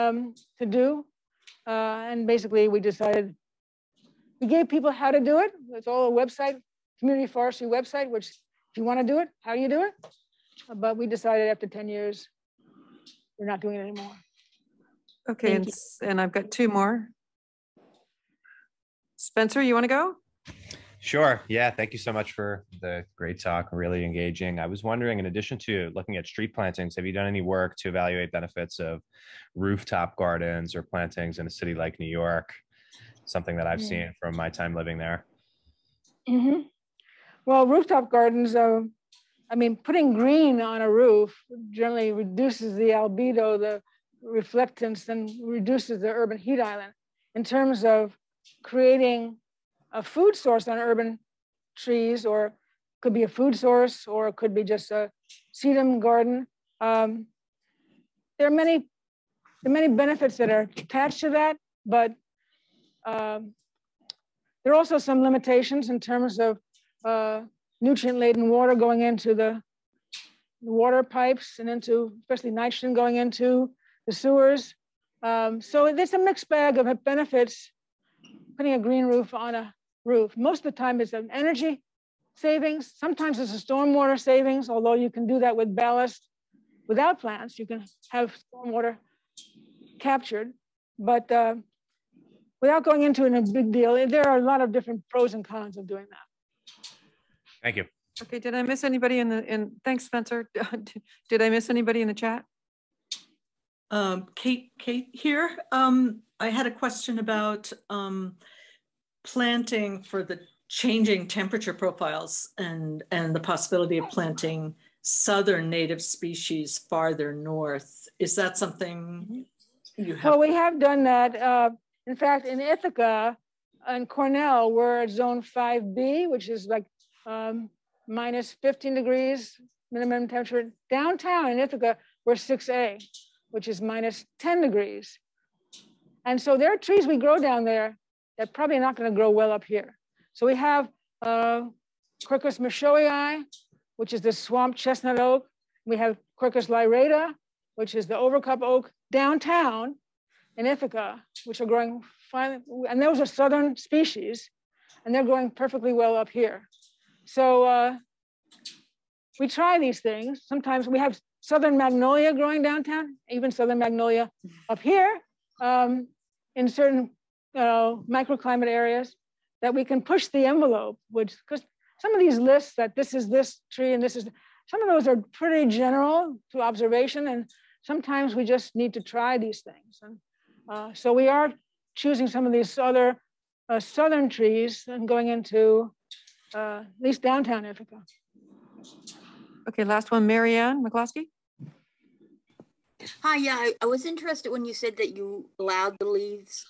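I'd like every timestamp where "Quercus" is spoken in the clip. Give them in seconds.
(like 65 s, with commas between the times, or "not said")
142 s, 146 s.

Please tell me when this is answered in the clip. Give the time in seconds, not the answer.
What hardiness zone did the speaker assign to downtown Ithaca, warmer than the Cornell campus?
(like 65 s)
132 s.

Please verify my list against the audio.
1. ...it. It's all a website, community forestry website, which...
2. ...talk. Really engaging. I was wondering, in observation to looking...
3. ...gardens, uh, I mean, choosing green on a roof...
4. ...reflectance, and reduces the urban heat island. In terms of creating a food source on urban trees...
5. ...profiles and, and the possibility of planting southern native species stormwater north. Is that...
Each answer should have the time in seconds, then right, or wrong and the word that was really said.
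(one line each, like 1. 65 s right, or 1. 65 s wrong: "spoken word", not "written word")
1. 5 s right
2. 23 s wrong: "addition", not "observation"
3. 38 s wrong: "putting", not "choosing"
4. 44 s right
5. 111 s wrong: "farther", not "stormwater".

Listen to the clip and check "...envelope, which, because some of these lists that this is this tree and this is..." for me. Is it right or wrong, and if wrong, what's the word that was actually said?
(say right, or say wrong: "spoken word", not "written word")
right.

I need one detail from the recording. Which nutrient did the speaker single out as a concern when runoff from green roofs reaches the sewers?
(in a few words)
nitrogen.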